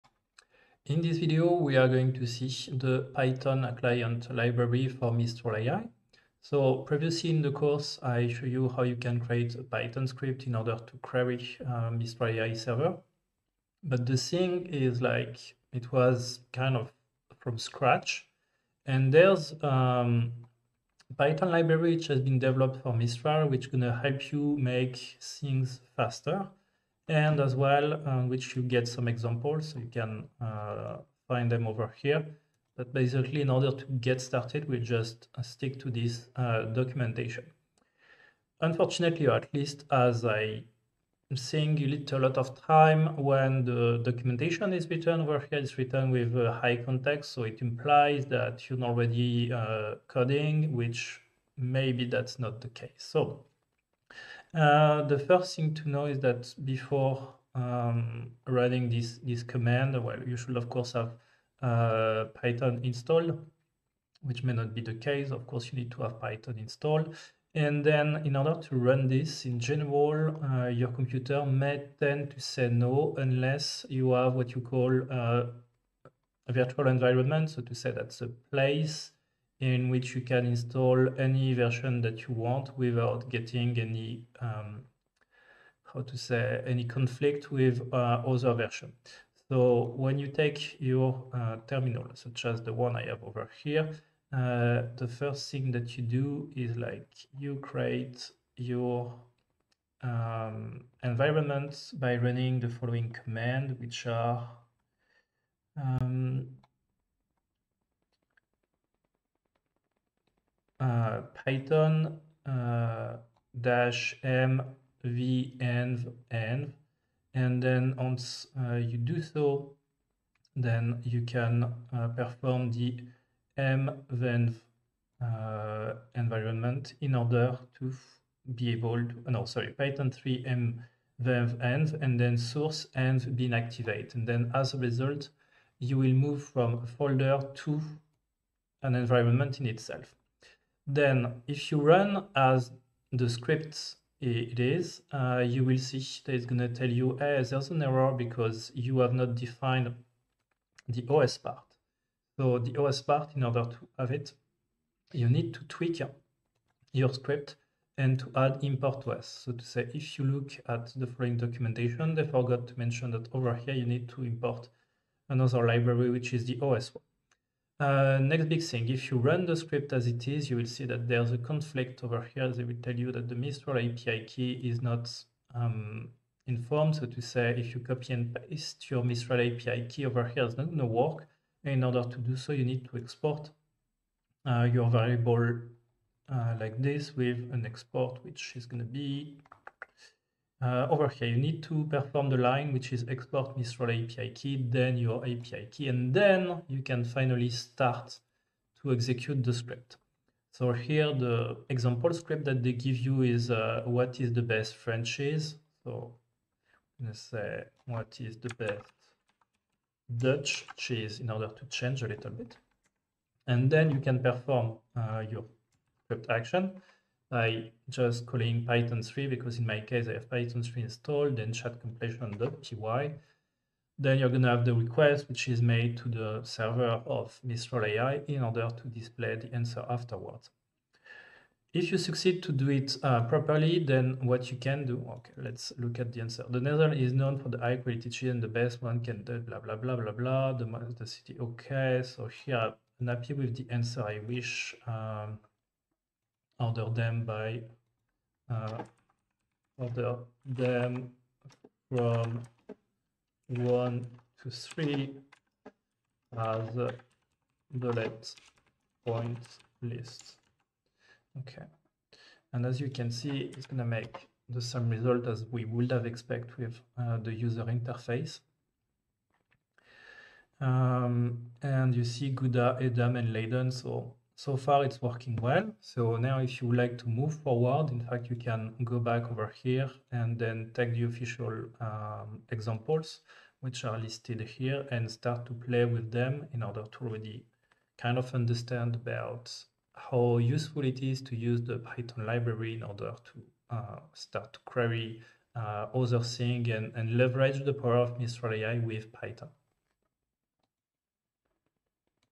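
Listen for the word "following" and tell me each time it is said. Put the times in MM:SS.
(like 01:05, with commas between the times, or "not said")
01:42, 02:41.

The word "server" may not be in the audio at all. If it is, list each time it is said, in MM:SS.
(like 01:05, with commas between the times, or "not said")
00:12, 03:46.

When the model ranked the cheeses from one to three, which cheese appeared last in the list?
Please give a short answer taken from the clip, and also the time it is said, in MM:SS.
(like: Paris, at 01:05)
Leiden, at 04:33.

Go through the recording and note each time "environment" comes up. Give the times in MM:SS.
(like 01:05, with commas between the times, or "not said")
01:16, 01:41, 02:06, 02:18.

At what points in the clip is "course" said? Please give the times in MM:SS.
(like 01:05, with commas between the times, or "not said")
00:07, 01:00, 01:05.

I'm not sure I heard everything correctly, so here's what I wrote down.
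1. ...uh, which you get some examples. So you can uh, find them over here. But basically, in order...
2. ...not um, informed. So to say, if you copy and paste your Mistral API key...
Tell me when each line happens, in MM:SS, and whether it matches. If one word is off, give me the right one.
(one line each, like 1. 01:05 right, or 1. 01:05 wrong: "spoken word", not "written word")
1. 00:28 right
2. 02:54 right.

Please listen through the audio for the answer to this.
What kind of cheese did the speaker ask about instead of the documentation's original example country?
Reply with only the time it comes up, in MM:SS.
03:30.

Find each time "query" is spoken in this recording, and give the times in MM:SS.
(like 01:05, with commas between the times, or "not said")
00:10, 04:54.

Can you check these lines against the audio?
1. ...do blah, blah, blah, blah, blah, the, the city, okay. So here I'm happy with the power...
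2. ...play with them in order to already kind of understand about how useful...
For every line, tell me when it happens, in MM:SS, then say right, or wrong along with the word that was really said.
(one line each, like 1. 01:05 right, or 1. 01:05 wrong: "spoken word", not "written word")
1. 03:59 wrong: "answer", not "power"
2. 04:45 right.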